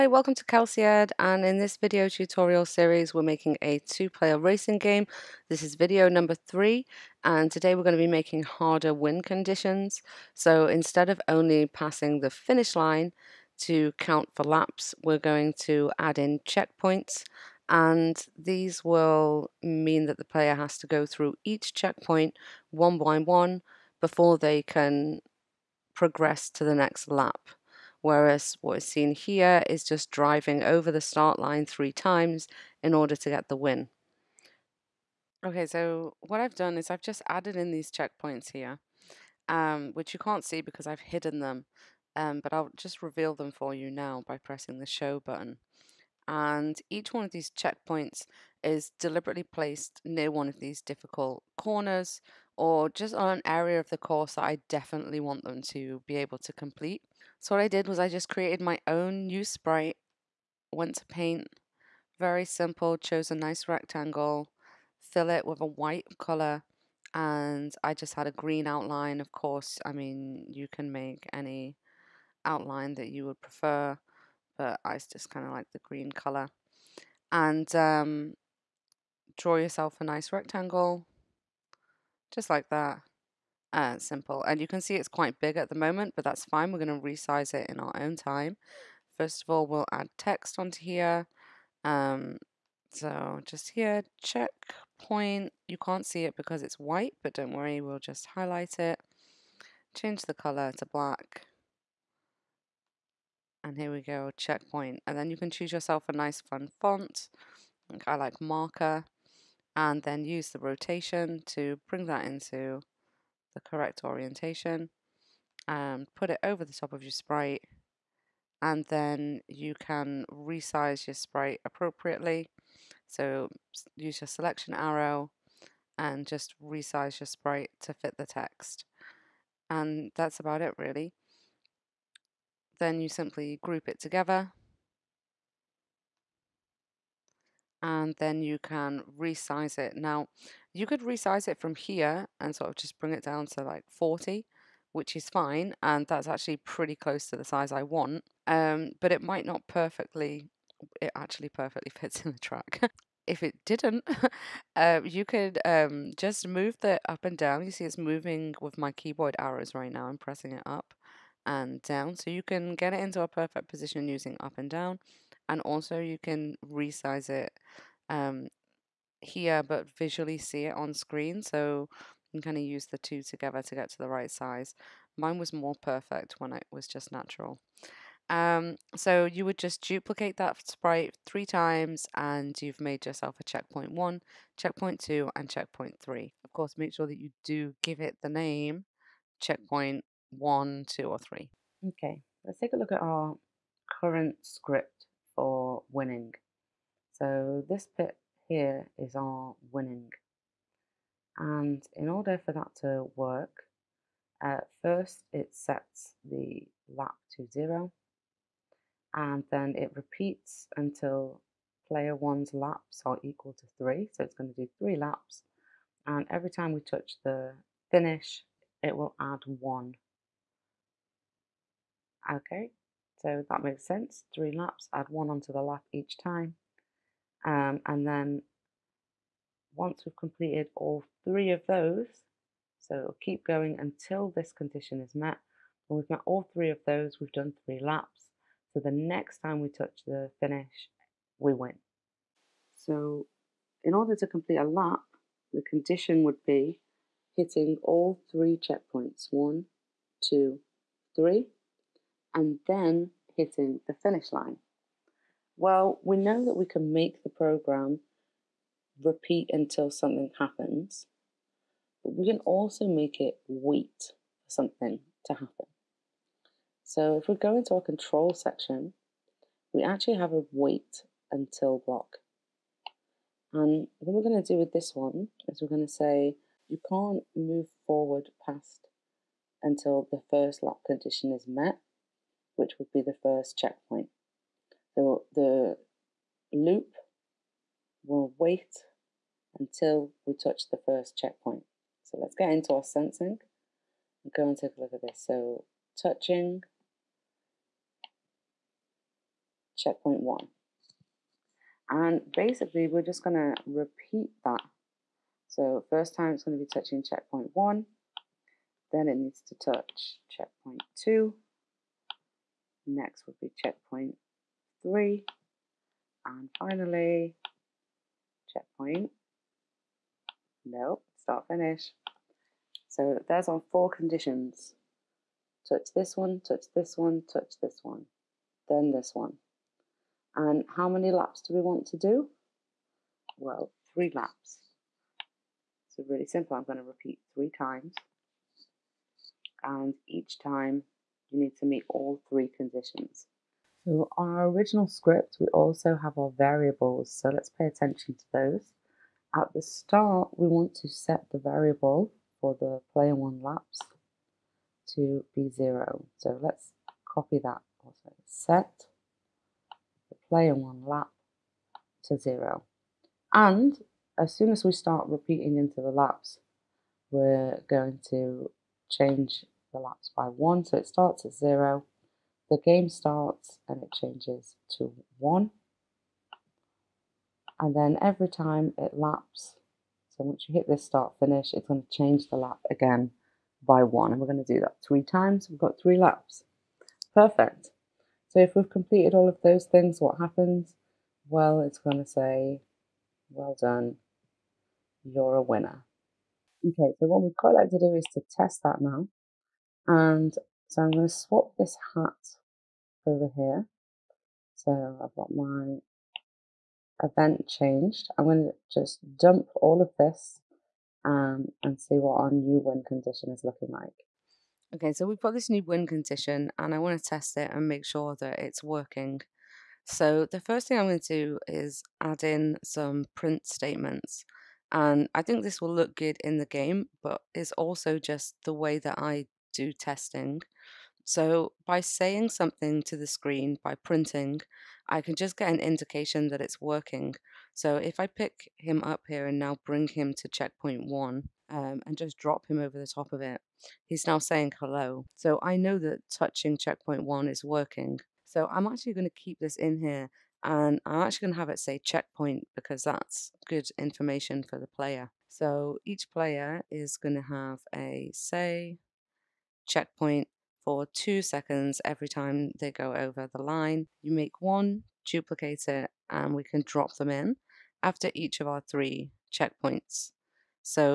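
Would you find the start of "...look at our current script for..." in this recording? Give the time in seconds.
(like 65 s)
192 s.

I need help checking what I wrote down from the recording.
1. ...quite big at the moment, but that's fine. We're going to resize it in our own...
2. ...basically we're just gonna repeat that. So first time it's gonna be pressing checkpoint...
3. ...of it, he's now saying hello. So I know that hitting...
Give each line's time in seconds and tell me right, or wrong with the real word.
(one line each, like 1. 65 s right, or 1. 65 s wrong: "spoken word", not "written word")
1. 85 s right
2. 302 s wrong: "touching", not "pressing"
3. 443 s wrong: "touching", not "hitting".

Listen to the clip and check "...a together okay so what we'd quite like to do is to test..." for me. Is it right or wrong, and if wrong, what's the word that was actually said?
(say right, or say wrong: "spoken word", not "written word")
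wrong: "winner", not "together".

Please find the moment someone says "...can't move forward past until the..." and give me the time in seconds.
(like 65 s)
276 s.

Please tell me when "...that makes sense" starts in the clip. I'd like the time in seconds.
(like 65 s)
223 s.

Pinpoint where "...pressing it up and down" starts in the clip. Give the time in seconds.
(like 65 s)
160 s.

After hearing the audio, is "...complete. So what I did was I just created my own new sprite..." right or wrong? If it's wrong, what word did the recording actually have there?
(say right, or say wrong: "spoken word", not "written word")
right.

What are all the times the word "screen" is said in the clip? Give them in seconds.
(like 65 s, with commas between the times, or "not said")
170 s, 433 s.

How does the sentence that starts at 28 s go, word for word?
Whereas what is seen here is just driving over the start line three times in order to get the win.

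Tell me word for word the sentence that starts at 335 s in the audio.
So really simple, I'm going to repeat three times.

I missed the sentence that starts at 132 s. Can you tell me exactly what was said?
Then you simply group it together and then you can resize it.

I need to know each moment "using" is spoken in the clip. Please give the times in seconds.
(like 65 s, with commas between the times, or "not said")
164 s.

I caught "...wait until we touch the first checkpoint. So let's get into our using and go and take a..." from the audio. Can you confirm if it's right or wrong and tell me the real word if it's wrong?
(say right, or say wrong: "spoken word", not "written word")
wrong: "sensing", not "using".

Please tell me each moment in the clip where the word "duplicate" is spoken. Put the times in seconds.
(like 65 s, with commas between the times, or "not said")
179 s, 465 s.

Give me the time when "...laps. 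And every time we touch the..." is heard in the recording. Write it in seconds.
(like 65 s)
214 s.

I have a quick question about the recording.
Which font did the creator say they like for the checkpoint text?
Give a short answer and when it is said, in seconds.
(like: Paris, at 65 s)
Marker, at 108 s.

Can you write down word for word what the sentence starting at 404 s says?
So I've got my event changed.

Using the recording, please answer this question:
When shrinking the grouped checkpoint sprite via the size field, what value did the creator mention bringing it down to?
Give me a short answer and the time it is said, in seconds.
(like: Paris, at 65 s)
40, at 143 s.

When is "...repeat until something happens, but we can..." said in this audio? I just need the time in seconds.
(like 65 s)
259 s.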